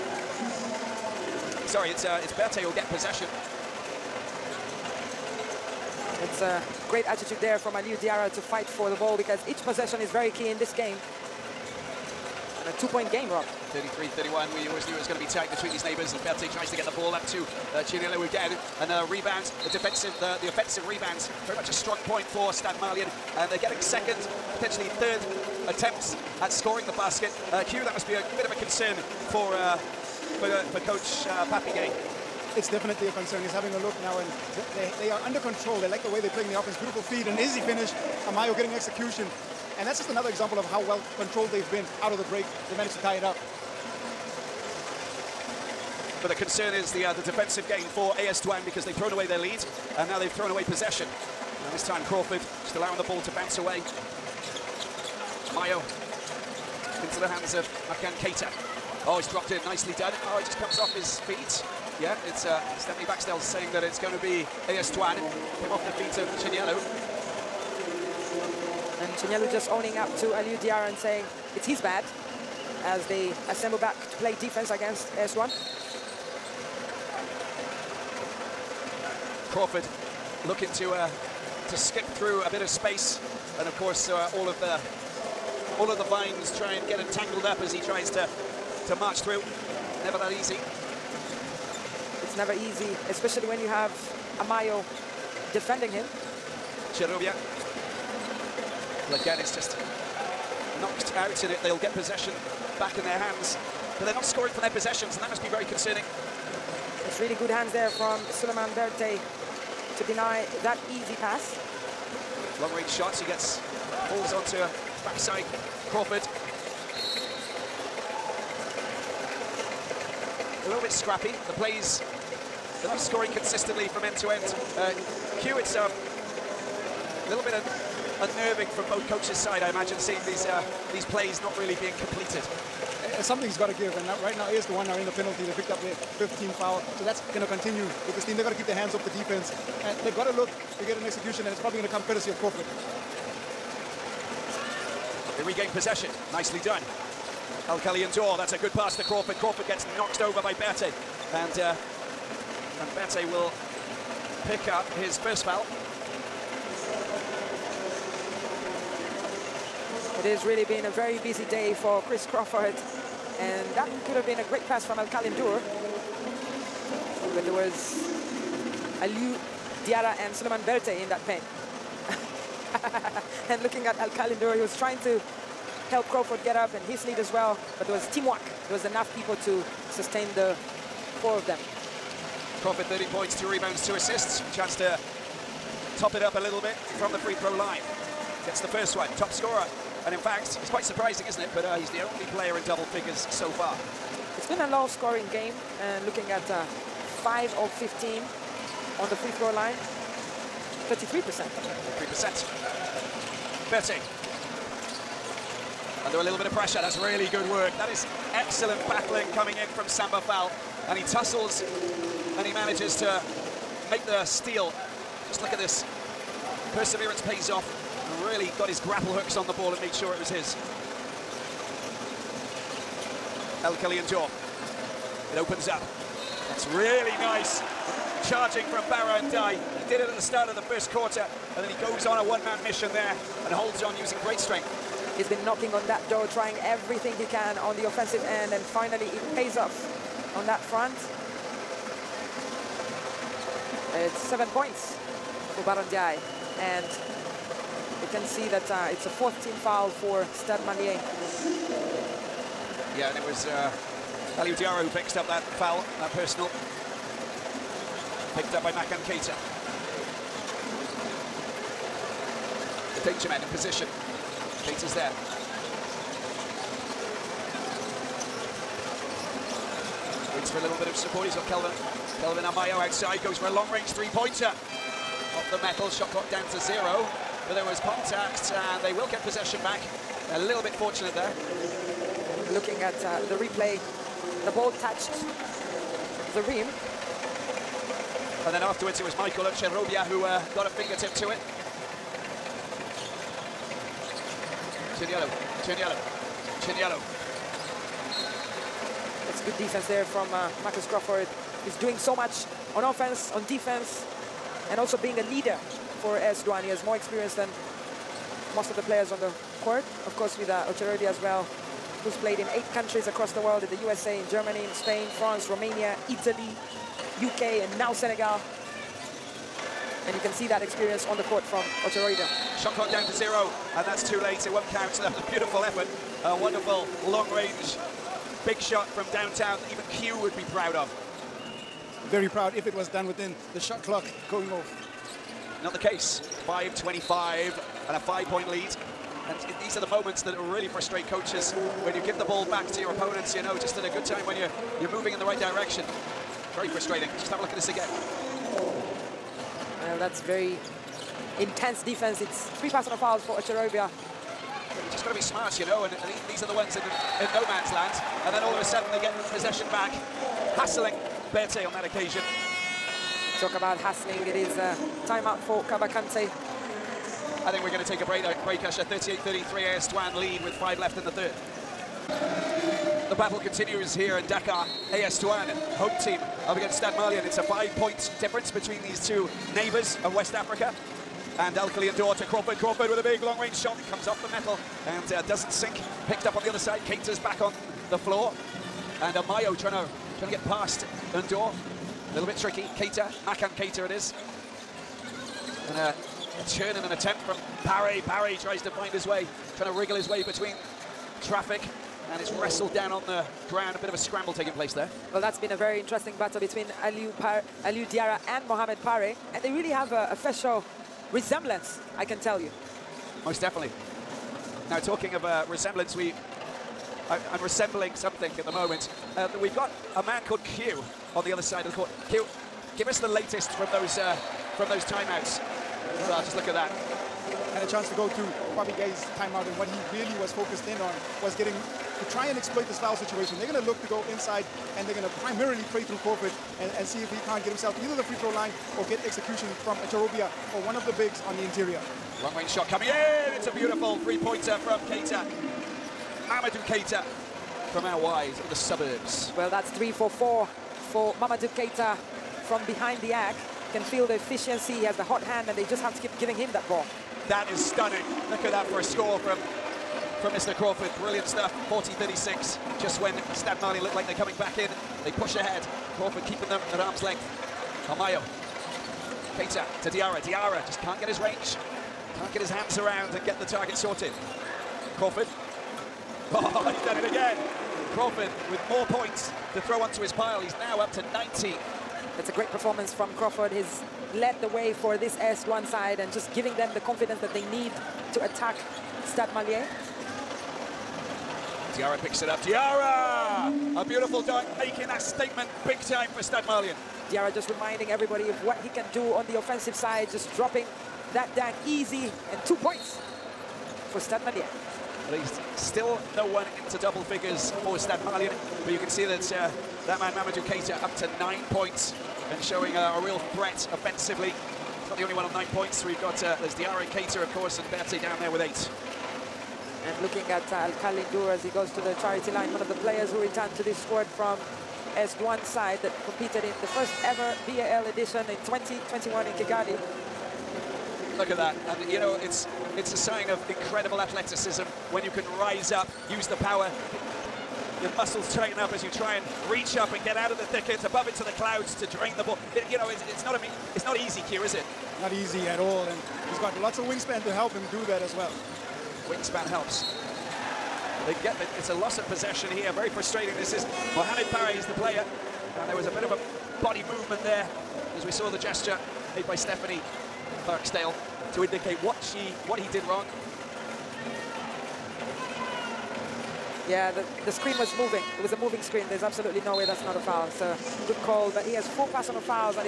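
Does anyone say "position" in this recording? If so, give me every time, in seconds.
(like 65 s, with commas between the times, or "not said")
263 s.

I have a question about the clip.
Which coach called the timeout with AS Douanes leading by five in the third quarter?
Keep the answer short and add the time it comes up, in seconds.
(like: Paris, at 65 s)
Kaba Kante, at 365 s.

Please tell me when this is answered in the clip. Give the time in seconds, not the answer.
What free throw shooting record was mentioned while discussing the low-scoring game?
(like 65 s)
197 s.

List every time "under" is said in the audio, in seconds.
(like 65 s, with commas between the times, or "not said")
35 s, 206 s.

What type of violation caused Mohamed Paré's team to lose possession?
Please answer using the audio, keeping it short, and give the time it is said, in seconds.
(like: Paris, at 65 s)
Moving screen, at 568 s.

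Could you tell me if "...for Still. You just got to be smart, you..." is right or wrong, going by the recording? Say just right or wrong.
wrong.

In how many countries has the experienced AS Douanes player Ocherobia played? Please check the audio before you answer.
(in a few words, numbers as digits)
8.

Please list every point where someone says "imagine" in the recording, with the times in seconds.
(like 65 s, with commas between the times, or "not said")
129 s.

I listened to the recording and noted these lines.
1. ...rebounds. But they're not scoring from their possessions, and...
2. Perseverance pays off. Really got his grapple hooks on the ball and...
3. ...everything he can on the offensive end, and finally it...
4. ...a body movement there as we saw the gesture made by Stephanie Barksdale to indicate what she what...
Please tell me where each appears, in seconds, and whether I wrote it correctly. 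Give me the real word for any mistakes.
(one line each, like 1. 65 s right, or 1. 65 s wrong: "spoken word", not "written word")
1. 103 s wrong: "hands", not "rebounds"
2. 216 s right
3. 236 s right
4. 556 s right.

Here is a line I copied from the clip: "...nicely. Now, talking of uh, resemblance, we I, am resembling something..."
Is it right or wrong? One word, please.
wrong.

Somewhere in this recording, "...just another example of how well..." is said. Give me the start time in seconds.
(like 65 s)
39 s.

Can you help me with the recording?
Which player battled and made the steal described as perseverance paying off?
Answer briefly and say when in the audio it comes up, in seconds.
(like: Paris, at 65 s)
Samba Fall, at 209 s.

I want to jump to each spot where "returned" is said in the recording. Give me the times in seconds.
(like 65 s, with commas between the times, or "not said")
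523 s.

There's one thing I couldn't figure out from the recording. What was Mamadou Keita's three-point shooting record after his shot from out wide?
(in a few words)
3 for 4.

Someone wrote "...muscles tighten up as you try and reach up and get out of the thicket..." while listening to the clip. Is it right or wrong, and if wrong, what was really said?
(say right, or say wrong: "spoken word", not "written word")
right.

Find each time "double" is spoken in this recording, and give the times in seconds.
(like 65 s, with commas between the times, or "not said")
192 s, 506 s.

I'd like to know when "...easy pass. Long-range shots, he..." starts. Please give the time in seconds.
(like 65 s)
110 s.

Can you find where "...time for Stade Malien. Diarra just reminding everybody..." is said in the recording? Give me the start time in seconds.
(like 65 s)
495 s.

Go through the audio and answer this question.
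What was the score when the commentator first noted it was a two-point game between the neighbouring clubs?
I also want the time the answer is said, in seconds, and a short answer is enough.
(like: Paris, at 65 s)
33-31, at 13 s.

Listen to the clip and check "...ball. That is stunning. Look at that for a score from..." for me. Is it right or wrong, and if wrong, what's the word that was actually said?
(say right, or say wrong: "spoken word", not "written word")
right.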